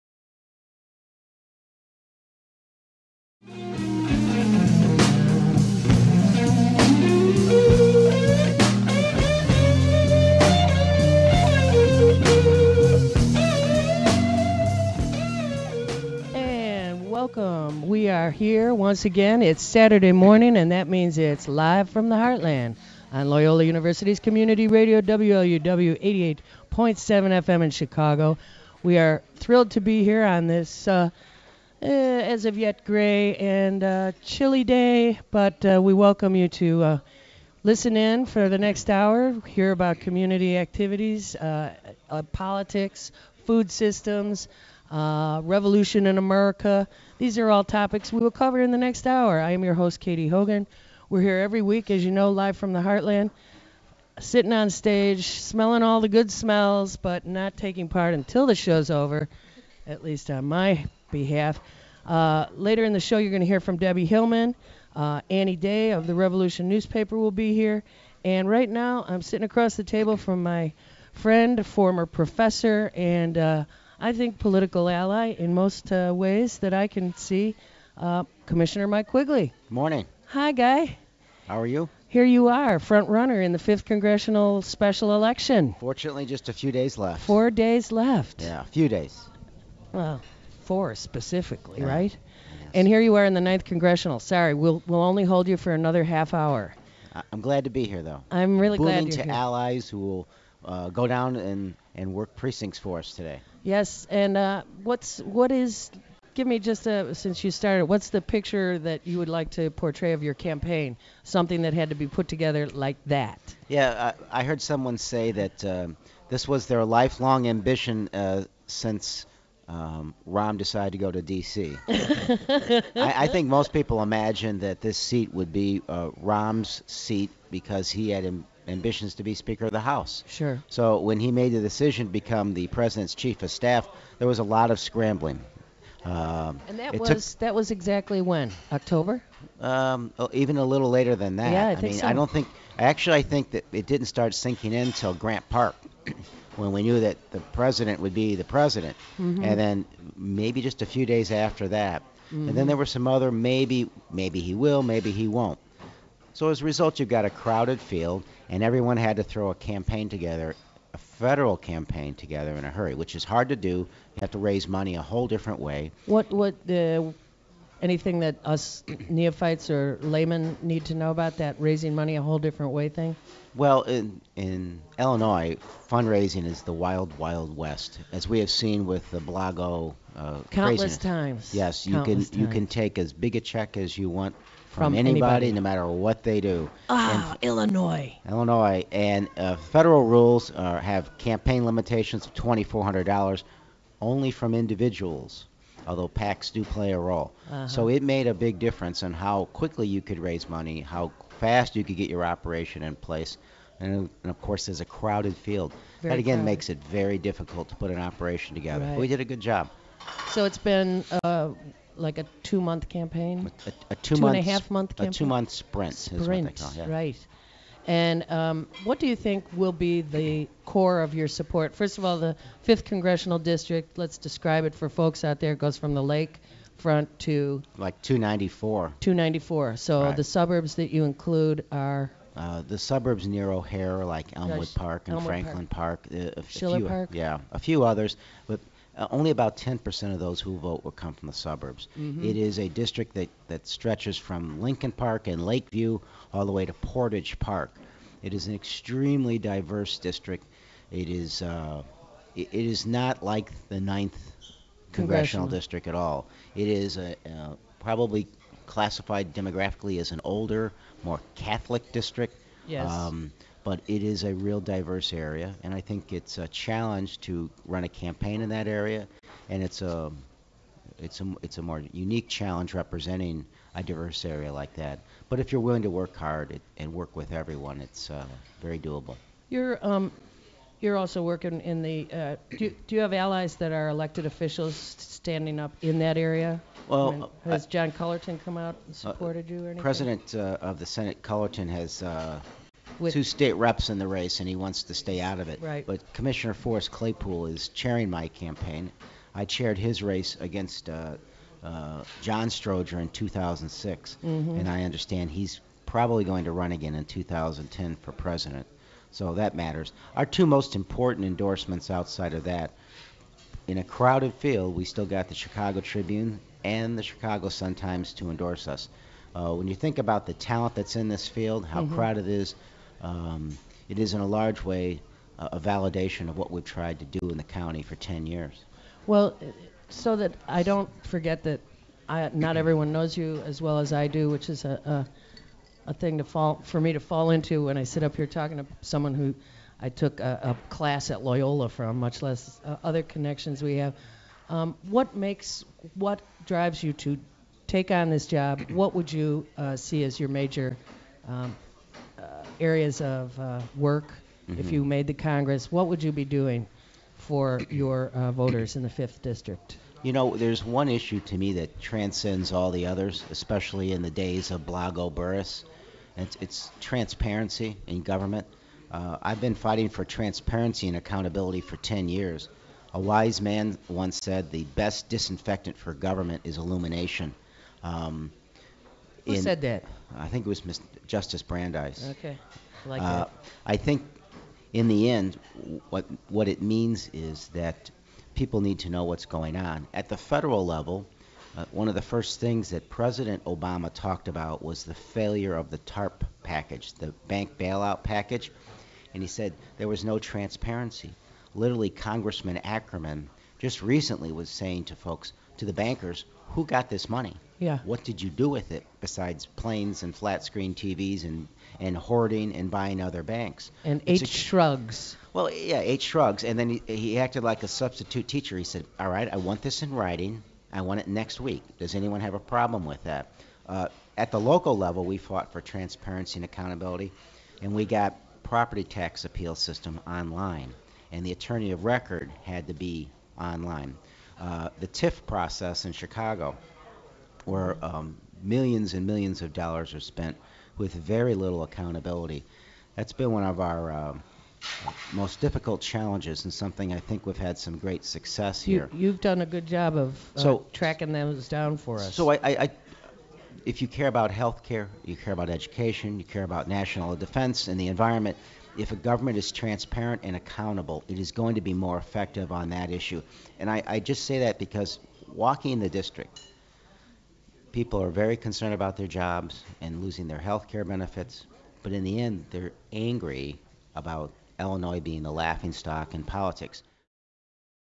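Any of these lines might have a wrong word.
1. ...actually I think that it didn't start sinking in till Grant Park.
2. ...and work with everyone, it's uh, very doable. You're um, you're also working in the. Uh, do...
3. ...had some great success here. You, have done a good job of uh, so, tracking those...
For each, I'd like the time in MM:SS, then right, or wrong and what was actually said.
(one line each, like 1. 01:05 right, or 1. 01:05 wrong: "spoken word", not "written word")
1. 02:22 right
2. 04:36 right
3. 07:27 right.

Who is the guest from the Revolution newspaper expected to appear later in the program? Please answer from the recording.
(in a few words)
Annie Day.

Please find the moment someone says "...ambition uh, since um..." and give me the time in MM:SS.
01:57.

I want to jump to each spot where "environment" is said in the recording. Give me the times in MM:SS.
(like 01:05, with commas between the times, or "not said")
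07:37.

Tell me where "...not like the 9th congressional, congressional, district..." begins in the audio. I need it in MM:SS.
04:12.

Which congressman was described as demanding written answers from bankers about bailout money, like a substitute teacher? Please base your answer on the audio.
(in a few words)
Ackerman.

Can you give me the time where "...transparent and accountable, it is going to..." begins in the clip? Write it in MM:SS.
07:39.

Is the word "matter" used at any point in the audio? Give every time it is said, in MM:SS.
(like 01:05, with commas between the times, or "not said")
03:05, 05:09.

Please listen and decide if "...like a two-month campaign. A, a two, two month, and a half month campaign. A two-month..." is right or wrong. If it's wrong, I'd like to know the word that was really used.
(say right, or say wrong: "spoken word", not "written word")
right.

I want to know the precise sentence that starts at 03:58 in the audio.
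But uh, only about 10% of those who vote will come from the suburbs.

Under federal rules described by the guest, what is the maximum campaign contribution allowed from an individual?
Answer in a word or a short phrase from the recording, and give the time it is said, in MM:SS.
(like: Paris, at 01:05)
$2,400, at 03:12.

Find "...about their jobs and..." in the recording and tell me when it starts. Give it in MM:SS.
07:48.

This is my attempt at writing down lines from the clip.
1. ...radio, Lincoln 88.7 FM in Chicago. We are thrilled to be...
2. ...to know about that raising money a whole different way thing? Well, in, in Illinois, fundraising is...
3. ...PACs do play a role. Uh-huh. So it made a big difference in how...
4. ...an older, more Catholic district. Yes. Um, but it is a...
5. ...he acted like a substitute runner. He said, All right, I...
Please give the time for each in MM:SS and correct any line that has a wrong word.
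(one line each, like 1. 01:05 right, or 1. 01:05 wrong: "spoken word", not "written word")
1. 00:24 wrong: "WLUW", not "Lincoln"
2. 02:50 right
3. 03:16 right
4. 04:20 right
5. 06:56 wrong: "teacher", not "runner".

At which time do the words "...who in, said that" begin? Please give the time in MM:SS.
06:19.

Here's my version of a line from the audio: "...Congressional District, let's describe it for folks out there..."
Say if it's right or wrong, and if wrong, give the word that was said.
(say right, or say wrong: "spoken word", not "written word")
right.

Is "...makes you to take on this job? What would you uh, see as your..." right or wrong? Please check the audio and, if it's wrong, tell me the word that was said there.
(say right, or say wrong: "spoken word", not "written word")
wrong: "drives", not "makes".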